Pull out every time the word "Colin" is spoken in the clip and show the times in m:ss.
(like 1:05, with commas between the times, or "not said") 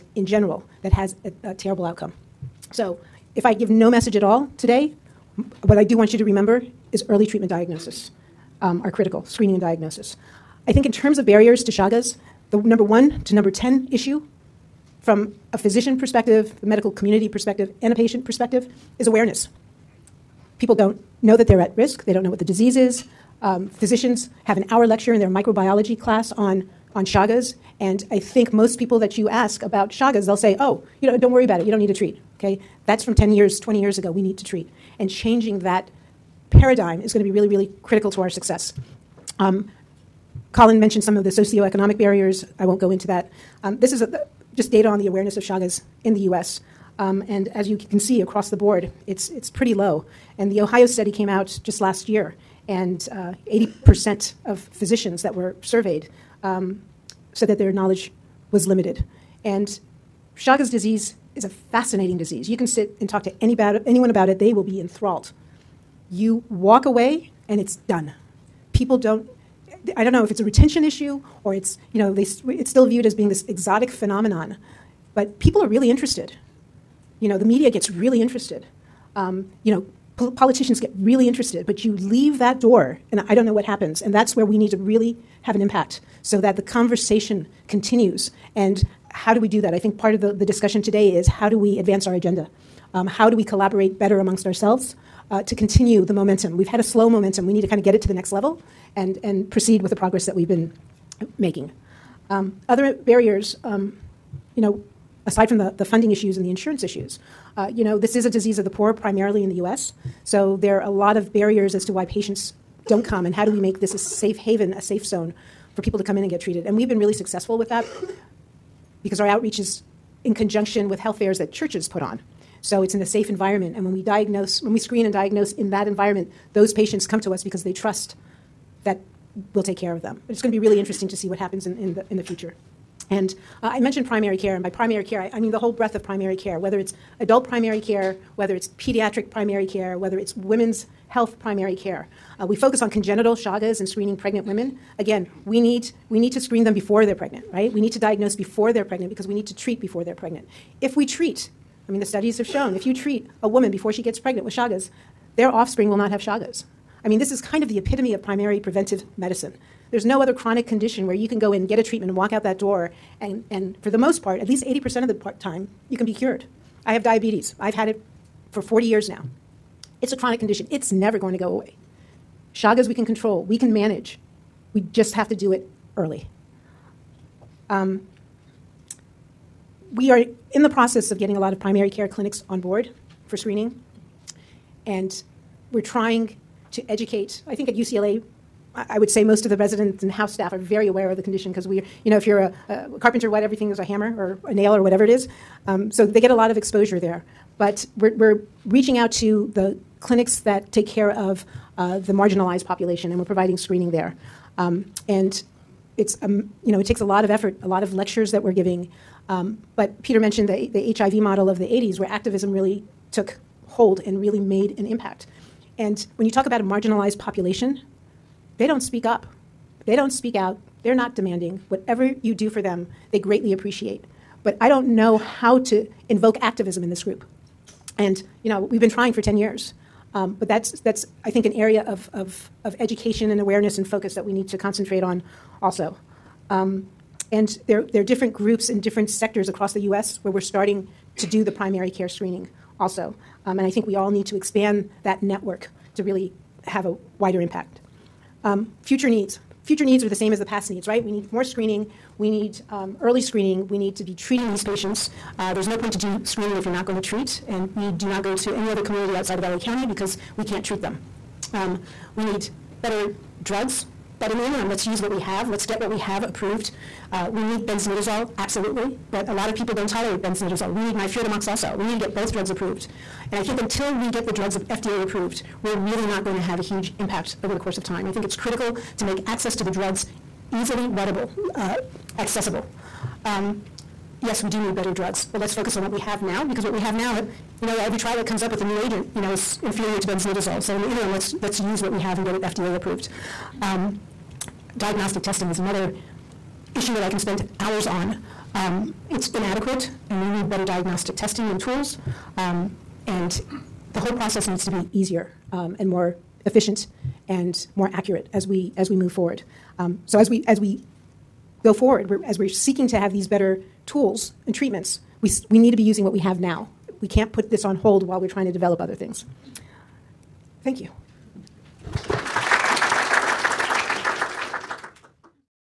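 0:40.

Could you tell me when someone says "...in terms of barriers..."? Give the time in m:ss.
0:10.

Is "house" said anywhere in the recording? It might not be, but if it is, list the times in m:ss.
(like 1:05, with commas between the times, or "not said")
3:10.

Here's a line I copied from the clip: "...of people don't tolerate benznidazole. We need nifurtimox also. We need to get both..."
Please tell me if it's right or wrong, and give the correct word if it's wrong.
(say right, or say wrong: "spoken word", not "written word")
right.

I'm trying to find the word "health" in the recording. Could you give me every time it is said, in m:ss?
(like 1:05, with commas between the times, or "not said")
2:00, 2:21.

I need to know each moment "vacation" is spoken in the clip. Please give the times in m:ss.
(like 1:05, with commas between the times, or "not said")
not said.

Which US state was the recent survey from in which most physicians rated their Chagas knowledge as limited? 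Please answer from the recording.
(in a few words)
Ohio.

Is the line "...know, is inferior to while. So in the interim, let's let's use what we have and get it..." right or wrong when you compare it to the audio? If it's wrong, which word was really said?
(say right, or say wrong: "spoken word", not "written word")
wrong: "benznidazole", not "while".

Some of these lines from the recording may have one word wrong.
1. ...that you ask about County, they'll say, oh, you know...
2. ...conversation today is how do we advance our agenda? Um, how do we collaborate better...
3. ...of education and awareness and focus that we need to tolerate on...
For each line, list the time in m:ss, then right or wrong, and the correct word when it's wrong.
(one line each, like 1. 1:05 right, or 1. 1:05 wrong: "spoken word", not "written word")
1. 0:28 wrong: "Chagas", not "County"
2. 1:30 wrong: "discussion", not "conversation"
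3. 3:52 wrong: "concentrate", not "tolerate".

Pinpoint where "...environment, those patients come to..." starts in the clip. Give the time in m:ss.
2:05.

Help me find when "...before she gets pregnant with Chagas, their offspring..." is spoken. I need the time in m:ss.
2:33.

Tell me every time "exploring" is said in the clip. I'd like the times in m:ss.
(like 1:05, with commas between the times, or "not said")
not said.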